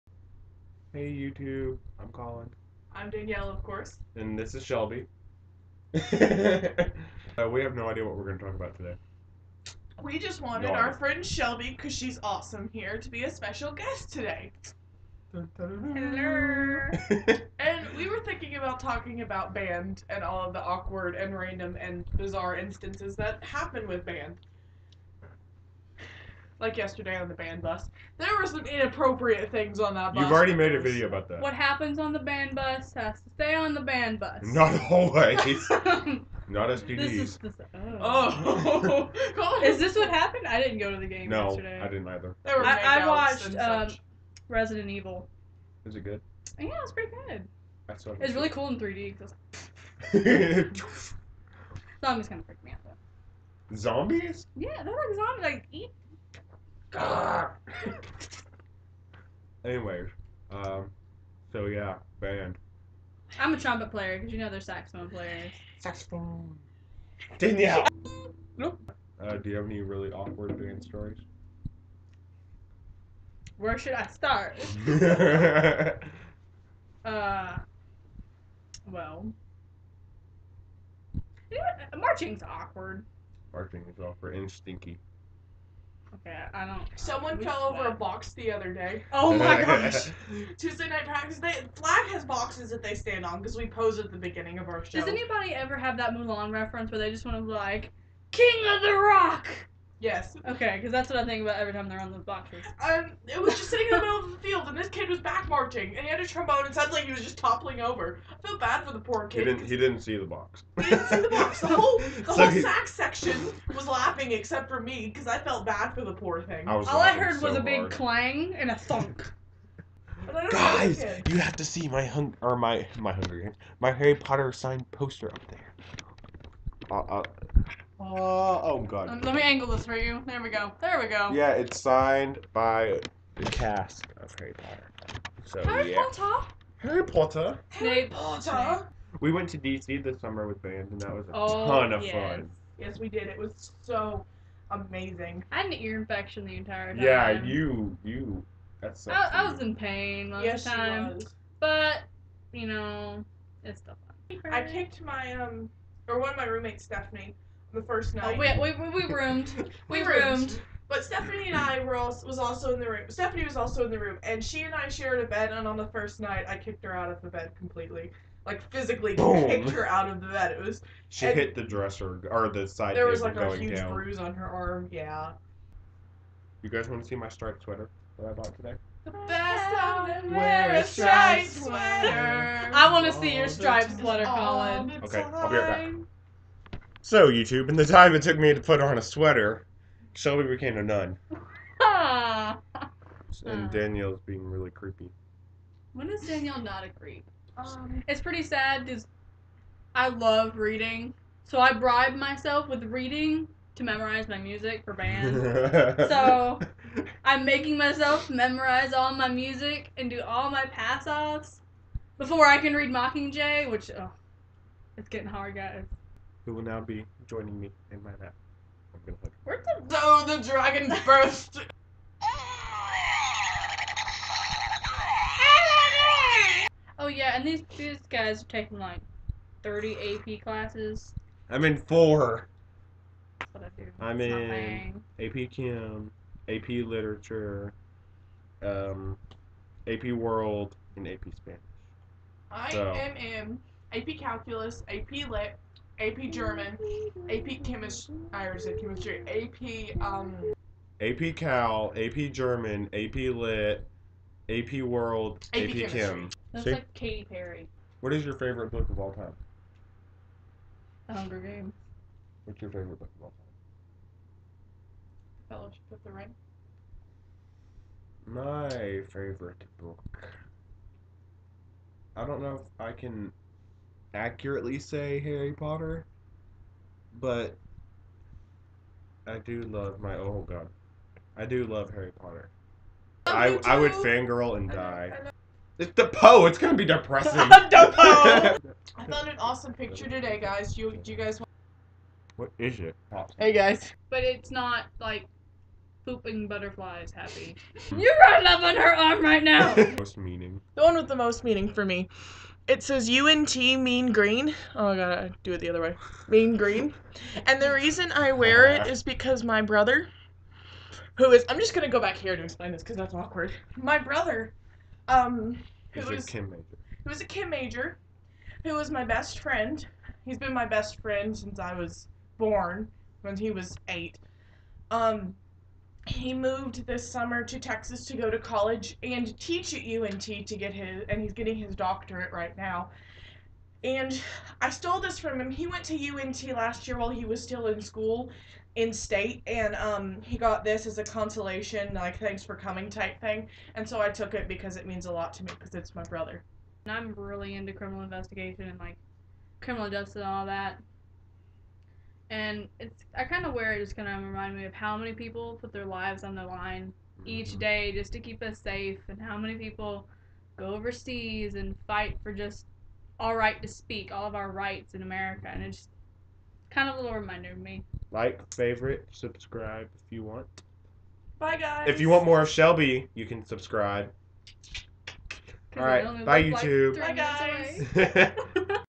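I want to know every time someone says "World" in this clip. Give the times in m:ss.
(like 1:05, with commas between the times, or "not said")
4:00, 4:14.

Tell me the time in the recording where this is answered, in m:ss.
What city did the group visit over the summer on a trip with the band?
2:19.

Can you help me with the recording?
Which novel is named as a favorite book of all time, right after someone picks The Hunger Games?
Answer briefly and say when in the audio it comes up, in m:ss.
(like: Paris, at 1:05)
Fellowship of the Ring, at 4:25.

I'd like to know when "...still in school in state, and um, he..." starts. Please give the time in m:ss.
5:37.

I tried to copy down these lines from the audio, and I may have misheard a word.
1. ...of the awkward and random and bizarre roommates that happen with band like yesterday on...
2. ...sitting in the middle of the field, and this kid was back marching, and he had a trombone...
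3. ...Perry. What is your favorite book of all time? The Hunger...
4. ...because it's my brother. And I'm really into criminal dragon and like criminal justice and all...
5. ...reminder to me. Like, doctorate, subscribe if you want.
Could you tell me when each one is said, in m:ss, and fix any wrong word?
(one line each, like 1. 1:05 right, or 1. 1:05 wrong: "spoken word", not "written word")
1. 0:20 wrong: "instances", not "roommates"
2. 1:43 right
3. 4:17 right
4. 5:45 wrong: "investigation", not "dragon"
5. 6:07 wrong: "favorite", not "doctorate".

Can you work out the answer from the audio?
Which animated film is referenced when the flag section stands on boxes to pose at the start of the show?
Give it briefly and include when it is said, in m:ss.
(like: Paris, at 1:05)
Mulan, at 1:36.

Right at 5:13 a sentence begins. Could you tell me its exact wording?
My brother, um, who was, Chem major.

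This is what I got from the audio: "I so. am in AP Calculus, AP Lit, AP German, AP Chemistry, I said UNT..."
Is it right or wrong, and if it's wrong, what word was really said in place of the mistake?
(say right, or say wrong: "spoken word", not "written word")
wrong: "Chemistry", not "UNT".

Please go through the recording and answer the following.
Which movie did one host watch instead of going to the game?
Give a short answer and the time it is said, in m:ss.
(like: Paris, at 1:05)
Resident Evil, at 0:44.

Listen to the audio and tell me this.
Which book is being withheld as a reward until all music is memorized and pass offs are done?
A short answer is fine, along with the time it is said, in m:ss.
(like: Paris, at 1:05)
Mockingjay, at 3:32.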